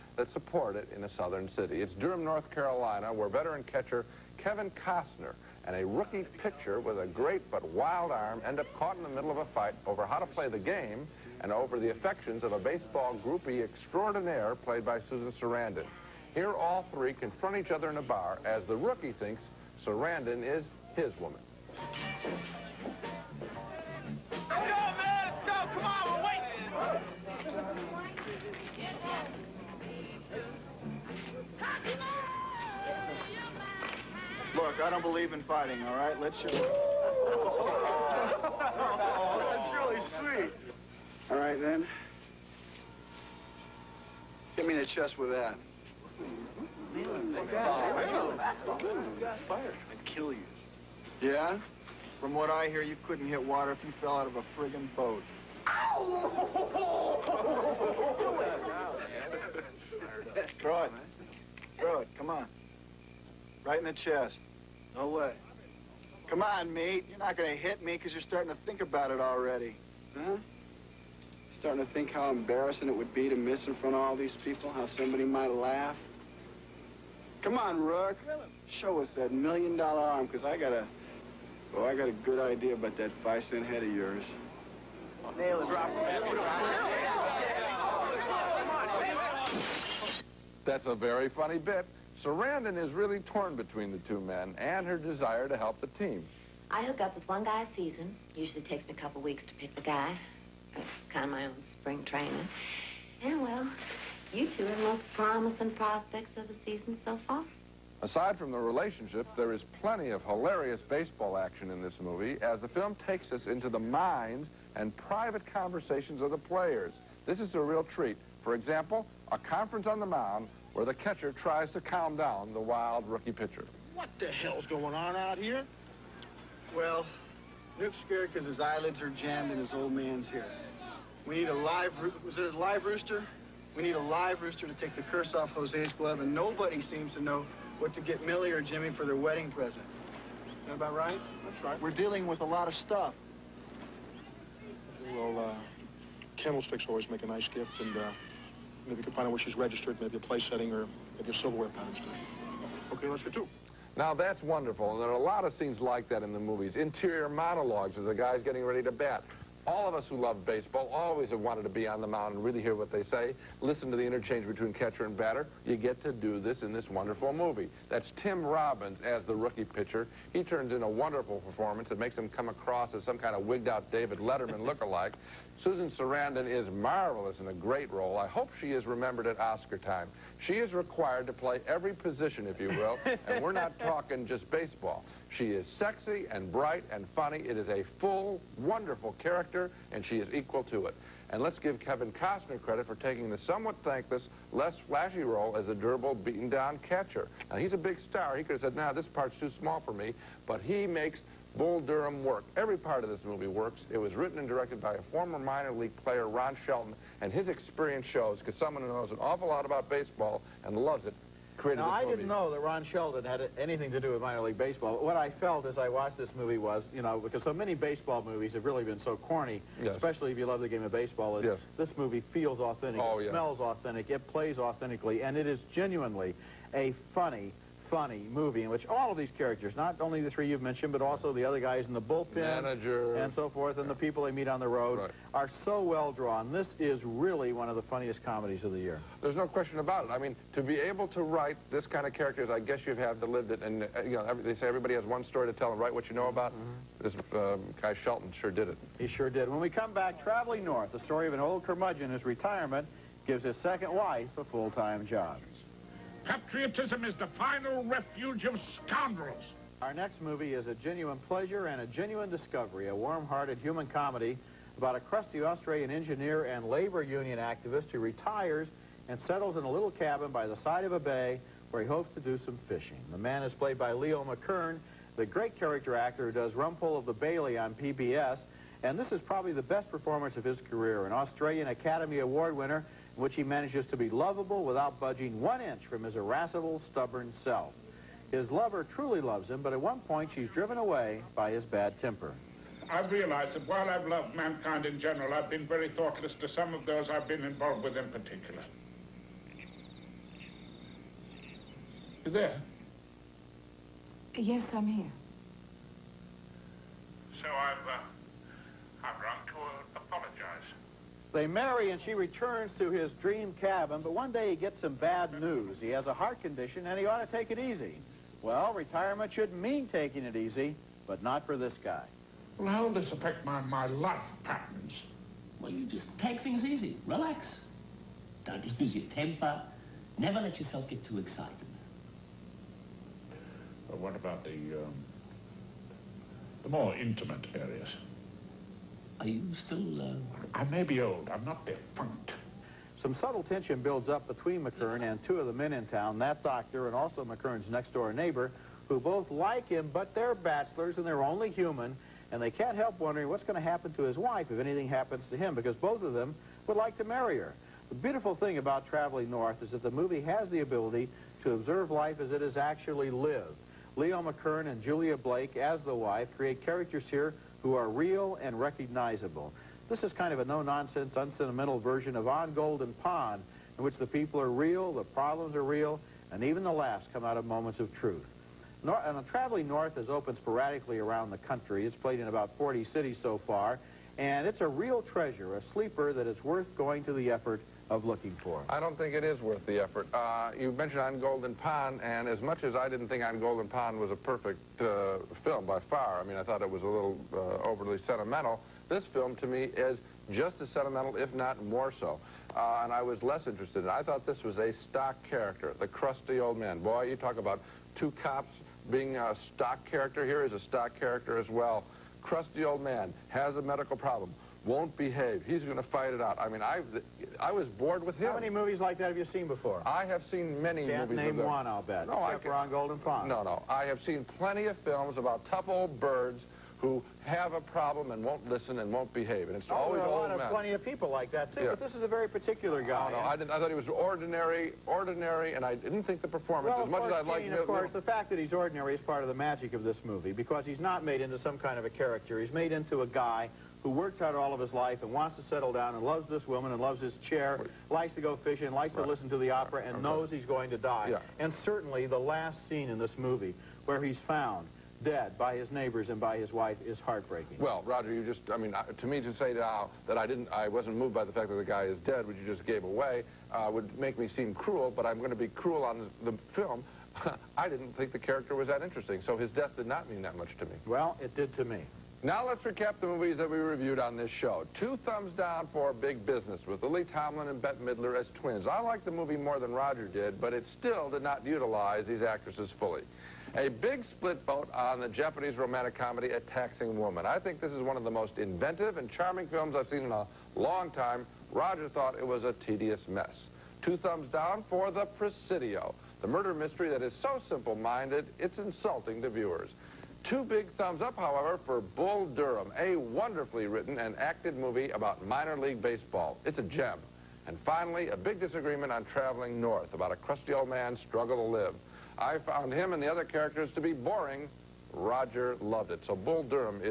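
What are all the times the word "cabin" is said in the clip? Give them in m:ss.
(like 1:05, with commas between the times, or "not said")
4:29, 5:13.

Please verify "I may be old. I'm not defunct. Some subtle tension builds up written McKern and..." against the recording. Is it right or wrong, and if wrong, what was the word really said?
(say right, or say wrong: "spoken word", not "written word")
wrong: "between", not "written".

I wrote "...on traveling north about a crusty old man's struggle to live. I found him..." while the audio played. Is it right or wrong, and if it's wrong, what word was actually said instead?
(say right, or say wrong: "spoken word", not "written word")
right.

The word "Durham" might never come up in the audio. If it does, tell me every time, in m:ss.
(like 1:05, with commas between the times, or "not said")
0:01, 3:21, 8:22.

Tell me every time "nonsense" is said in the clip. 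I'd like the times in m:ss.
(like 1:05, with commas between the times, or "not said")
6:10.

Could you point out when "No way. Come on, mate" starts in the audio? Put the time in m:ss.
1:04.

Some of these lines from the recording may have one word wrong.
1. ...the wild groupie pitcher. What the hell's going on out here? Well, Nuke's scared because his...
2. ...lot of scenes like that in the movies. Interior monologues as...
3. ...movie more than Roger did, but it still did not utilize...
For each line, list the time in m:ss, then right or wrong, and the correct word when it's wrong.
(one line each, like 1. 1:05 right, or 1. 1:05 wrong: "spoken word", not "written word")
1. 2:02 wrong: "rookie", not "groupie"
2. 2:35 right
3. 7:59 right.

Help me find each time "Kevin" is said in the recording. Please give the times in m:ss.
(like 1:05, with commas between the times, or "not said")
0:04, 3:11.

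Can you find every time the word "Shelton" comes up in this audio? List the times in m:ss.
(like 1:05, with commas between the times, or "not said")
3:26, 3:32, 4:08.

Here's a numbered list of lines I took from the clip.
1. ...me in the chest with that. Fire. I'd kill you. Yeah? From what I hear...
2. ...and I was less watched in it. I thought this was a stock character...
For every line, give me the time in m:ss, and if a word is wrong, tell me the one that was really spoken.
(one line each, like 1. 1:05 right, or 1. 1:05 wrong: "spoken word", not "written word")
1. 0:44 right
2. 6:42 wrong: "interested", not "watched".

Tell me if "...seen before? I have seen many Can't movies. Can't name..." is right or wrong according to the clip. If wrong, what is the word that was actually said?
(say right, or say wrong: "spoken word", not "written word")
right.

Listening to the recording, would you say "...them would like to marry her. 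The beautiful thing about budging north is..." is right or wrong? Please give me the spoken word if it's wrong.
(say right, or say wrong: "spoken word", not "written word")
wrong: "traveling", not "budging".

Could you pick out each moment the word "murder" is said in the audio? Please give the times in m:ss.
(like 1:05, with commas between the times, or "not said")
8:16.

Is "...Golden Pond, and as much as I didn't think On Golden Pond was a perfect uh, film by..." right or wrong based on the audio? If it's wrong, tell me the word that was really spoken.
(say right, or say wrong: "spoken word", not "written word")
right.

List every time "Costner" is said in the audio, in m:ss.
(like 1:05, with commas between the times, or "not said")
0:04, 3:12.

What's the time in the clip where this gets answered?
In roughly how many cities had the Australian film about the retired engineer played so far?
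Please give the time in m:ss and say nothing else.
6:22.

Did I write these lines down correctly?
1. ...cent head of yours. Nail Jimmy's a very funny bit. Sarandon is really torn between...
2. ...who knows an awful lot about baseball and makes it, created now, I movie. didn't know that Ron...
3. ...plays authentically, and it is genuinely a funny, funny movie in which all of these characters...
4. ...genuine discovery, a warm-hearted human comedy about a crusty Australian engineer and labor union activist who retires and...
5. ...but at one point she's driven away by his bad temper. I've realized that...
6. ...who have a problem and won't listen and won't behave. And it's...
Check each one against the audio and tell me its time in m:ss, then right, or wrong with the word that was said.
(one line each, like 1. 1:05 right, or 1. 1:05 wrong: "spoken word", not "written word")
1. 1:23 wrong: "That", not "Jimmy"
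2. 3:28 wrong: "loves", not "makes"
3. 3:44 right
4. 4:21 right
5. 4:49 right
6. 7:06 right.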